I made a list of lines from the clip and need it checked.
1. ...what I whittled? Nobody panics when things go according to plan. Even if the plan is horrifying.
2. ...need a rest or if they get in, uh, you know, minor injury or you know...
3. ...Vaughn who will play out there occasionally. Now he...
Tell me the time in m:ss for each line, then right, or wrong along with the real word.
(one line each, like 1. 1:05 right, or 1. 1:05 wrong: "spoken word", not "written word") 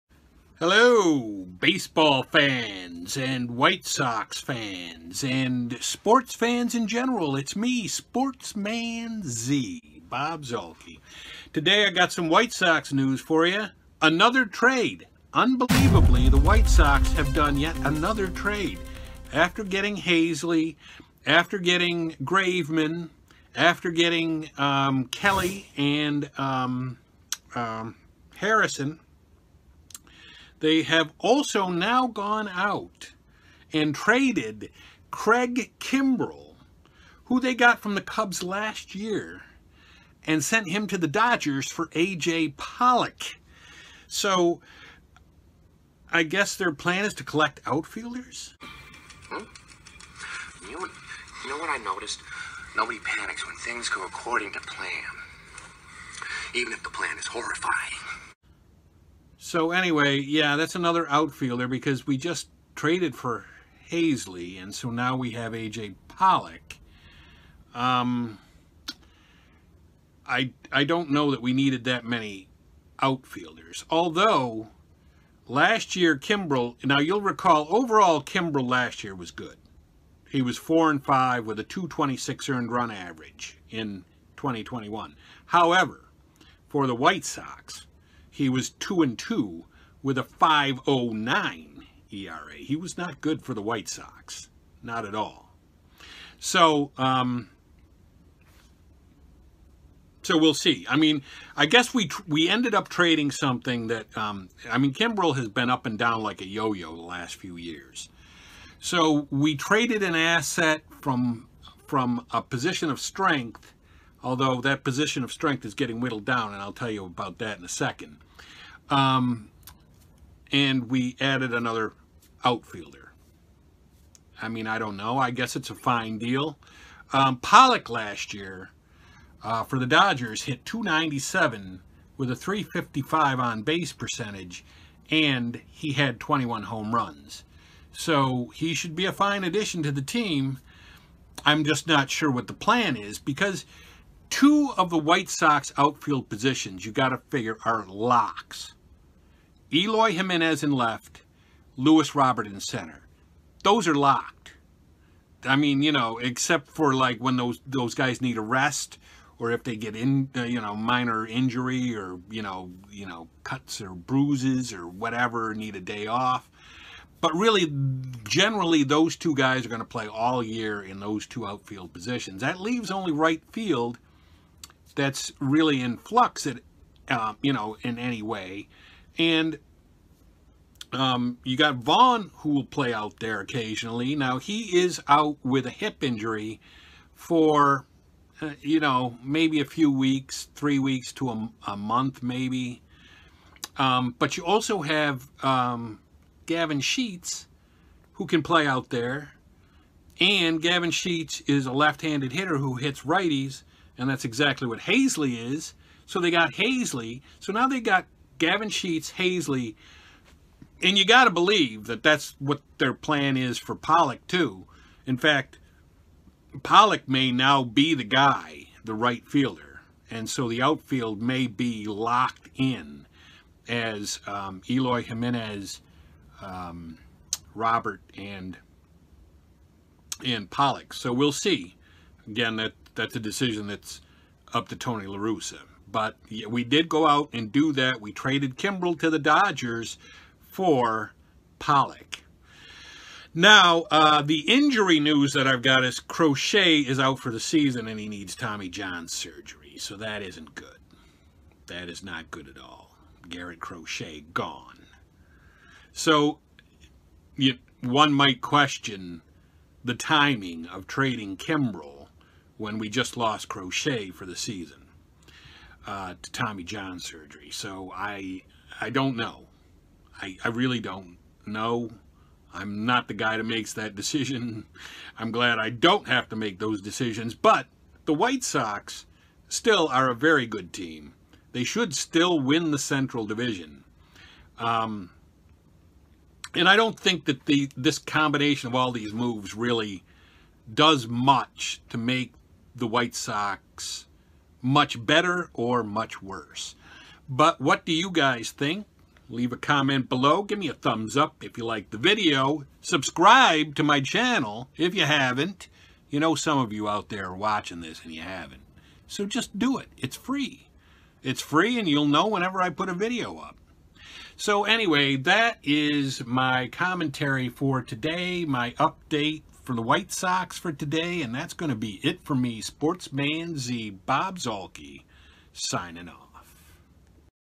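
1. 0:51 wrong: "noticed", not "whittled"
2. 2:38 right
3. 3:01 right.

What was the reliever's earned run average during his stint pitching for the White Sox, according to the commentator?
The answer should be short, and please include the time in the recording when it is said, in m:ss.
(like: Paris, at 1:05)
5.09, at 1:30.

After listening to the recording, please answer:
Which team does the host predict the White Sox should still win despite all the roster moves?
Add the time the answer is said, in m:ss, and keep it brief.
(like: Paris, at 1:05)
Central Division, at 4:42.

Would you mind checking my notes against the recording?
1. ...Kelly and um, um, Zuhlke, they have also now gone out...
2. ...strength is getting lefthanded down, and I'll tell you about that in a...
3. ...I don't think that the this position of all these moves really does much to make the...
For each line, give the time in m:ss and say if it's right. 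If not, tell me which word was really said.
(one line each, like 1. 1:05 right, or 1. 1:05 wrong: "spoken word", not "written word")
1. 0:25 wrong: "Harrison", not "Zuhlke"
2. 1:55 wrong: "whittled", not "lefthanded"
3. 4:46 wrong: "combination", not "position".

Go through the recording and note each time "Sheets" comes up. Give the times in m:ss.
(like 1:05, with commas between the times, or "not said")
3:16, 3:20, 3:28.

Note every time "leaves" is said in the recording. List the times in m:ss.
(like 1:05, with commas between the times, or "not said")
2:52, 4:59.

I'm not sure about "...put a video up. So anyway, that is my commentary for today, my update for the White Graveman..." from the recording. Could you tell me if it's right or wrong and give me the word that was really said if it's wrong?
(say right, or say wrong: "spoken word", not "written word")
wrong: "Sox", not "Graveman".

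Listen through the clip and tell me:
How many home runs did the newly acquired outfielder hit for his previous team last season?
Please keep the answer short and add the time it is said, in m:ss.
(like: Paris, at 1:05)
21, at 2:16.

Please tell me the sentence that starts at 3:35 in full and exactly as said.
In fact, Pollock may now be the guy, the right fielder.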